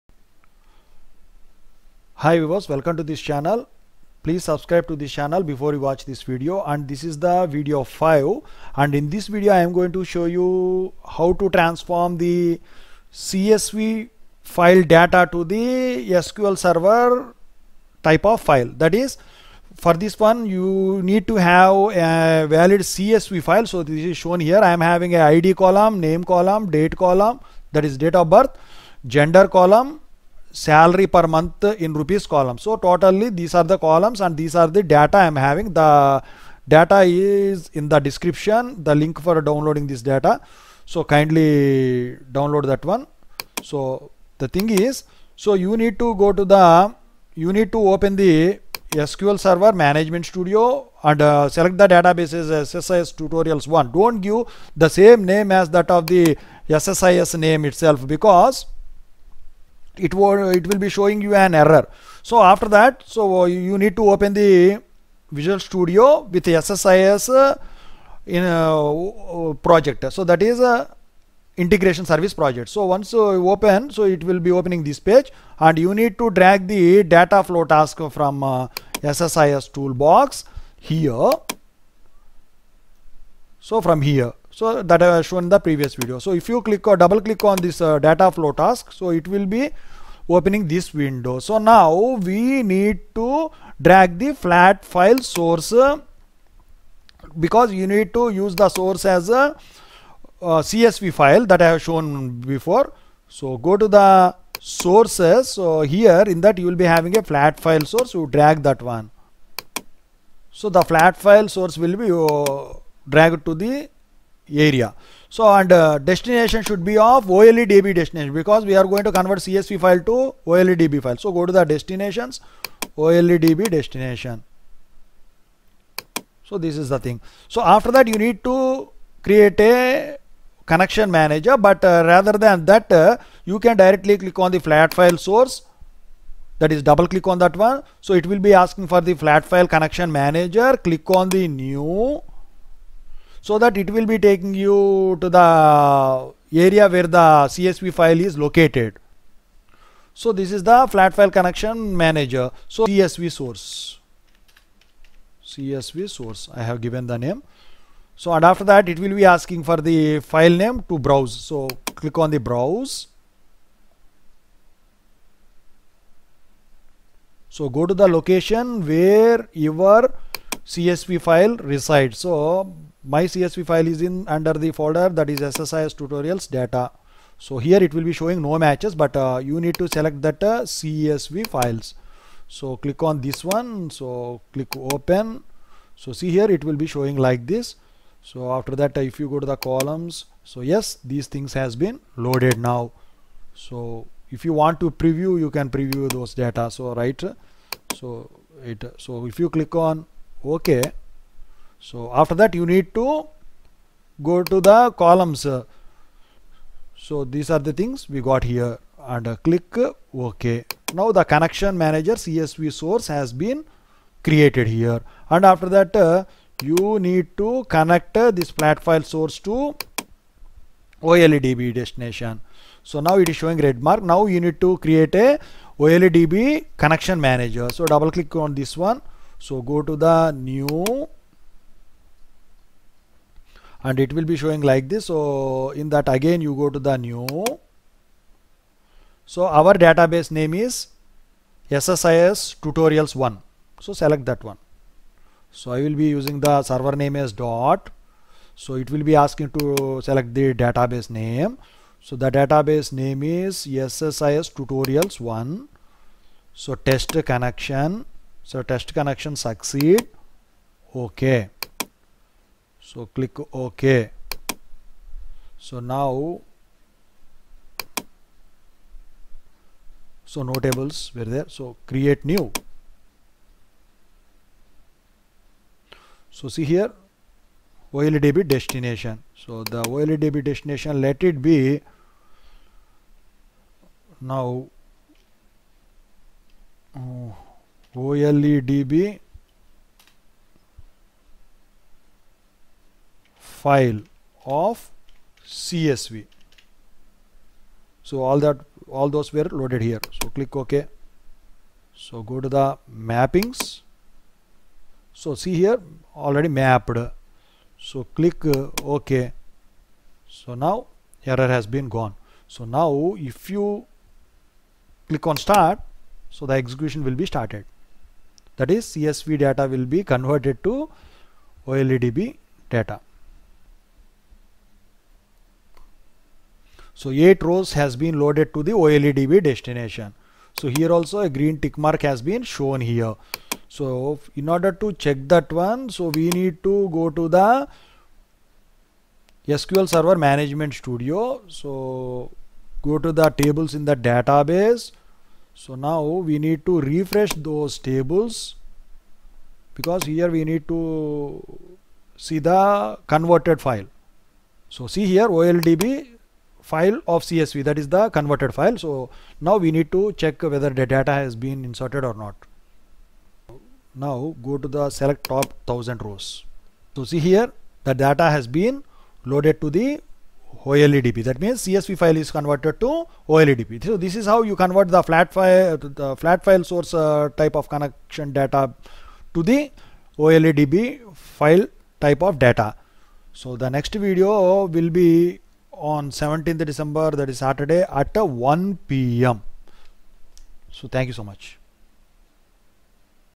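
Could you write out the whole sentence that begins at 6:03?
Now go to the select top 1000 rows.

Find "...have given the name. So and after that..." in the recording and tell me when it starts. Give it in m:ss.
2:36.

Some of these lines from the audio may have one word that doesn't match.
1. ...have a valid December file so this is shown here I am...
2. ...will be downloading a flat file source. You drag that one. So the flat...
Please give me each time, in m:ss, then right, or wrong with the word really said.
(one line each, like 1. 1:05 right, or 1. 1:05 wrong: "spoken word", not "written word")
1. 0:21 wrong: "CSV", not "December"
2. 1:46 wrong: "having", not "downloading".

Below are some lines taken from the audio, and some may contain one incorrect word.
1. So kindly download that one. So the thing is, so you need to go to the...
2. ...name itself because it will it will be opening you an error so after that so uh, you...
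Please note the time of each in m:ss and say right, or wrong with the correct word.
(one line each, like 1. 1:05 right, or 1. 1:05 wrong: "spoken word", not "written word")
1. 0:40 right
2. 0:57 wrong: "showing", not "opening".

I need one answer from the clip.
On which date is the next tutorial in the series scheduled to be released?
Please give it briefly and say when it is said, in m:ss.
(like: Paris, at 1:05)
17th December, at 6:26.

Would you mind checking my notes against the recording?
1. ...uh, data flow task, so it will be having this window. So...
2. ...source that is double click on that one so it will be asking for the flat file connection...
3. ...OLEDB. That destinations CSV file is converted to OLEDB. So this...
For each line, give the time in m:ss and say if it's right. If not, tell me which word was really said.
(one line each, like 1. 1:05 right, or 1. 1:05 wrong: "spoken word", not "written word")
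1. 1:27 wrong: "opening", not "having"
2. 2:15 right
3. 6:10 wrong: "means", not "destinations".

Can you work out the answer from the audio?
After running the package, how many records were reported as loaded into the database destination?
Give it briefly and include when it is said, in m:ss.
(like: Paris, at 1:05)
8, at 5:27.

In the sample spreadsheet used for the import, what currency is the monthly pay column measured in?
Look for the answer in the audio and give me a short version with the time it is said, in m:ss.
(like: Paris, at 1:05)
rupees, at 0:31.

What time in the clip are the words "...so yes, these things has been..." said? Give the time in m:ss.
3:10.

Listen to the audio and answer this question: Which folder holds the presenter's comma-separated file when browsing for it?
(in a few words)
SSIS tutorials data.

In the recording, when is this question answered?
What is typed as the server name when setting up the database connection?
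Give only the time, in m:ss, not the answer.
4:07.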